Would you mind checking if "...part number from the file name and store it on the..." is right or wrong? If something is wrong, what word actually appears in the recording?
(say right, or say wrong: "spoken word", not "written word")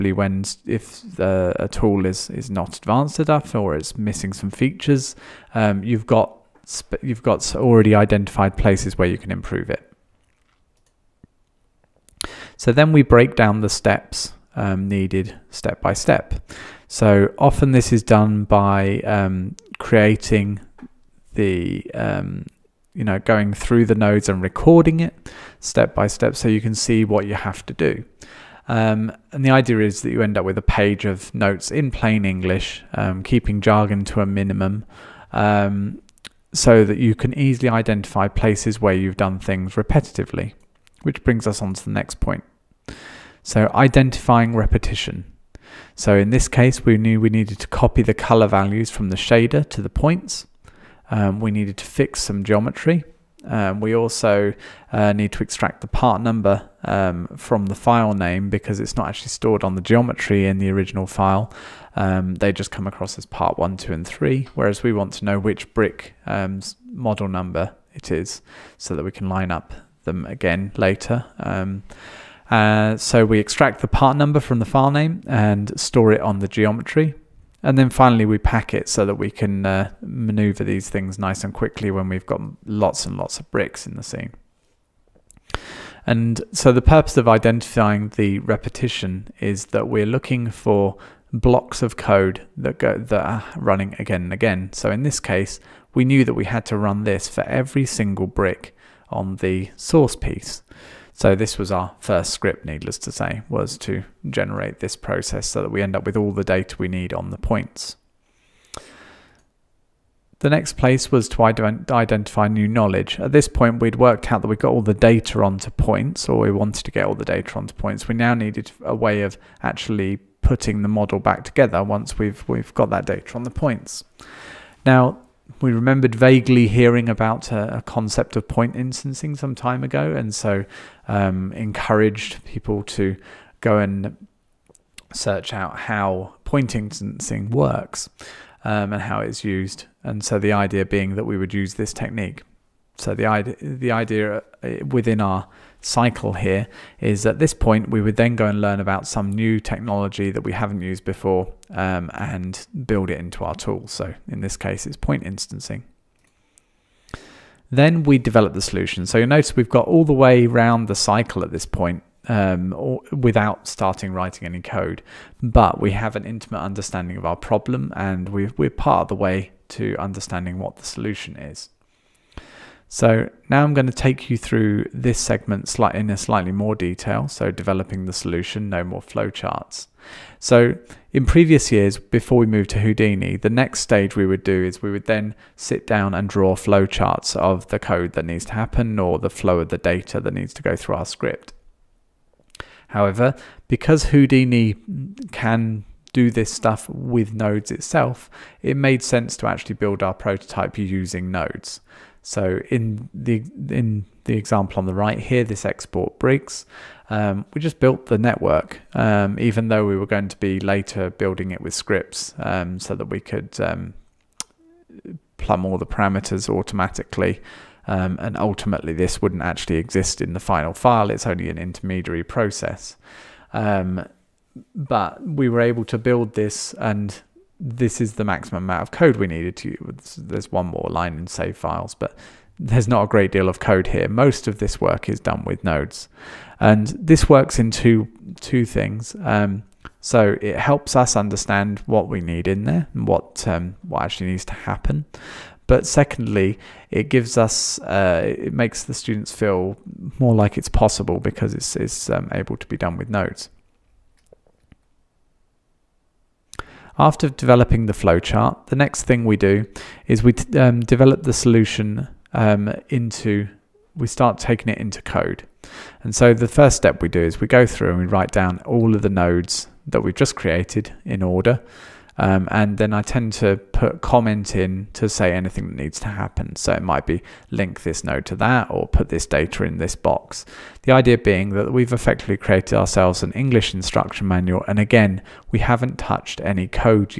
right.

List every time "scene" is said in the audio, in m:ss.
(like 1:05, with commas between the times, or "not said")
1:24.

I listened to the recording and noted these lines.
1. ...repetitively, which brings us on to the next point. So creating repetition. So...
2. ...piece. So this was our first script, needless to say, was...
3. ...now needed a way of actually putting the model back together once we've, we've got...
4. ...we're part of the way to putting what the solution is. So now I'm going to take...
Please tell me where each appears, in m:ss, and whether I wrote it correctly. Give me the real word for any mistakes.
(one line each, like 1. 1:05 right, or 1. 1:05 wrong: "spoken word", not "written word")
1. 0:39 wrong: "identifying", not "creating"
2. 1:40 right
3. 1:58 right
4. 2:48 wrong: "understanding", not "putting".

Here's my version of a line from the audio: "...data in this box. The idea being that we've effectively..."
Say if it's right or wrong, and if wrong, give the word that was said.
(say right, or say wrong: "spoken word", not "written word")
right.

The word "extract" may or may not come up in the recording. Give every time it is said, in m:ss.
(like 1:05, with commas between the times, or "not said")
0:55, 1:13.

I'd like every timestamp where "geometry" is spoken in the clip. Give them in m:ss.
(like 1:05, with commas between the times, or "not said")
0:52, 0:59, 1:16.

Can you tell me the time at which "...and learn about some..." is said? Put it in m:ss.
2:28.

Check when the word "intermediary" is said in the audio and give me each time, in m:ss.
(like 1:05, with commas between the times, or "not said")
3:41.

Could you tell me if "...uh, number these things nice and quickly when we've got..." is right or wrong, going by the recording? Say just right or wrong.
wrong.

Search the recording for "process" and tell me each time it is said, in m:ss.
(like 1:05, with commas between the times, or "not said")
1:44, 3:42.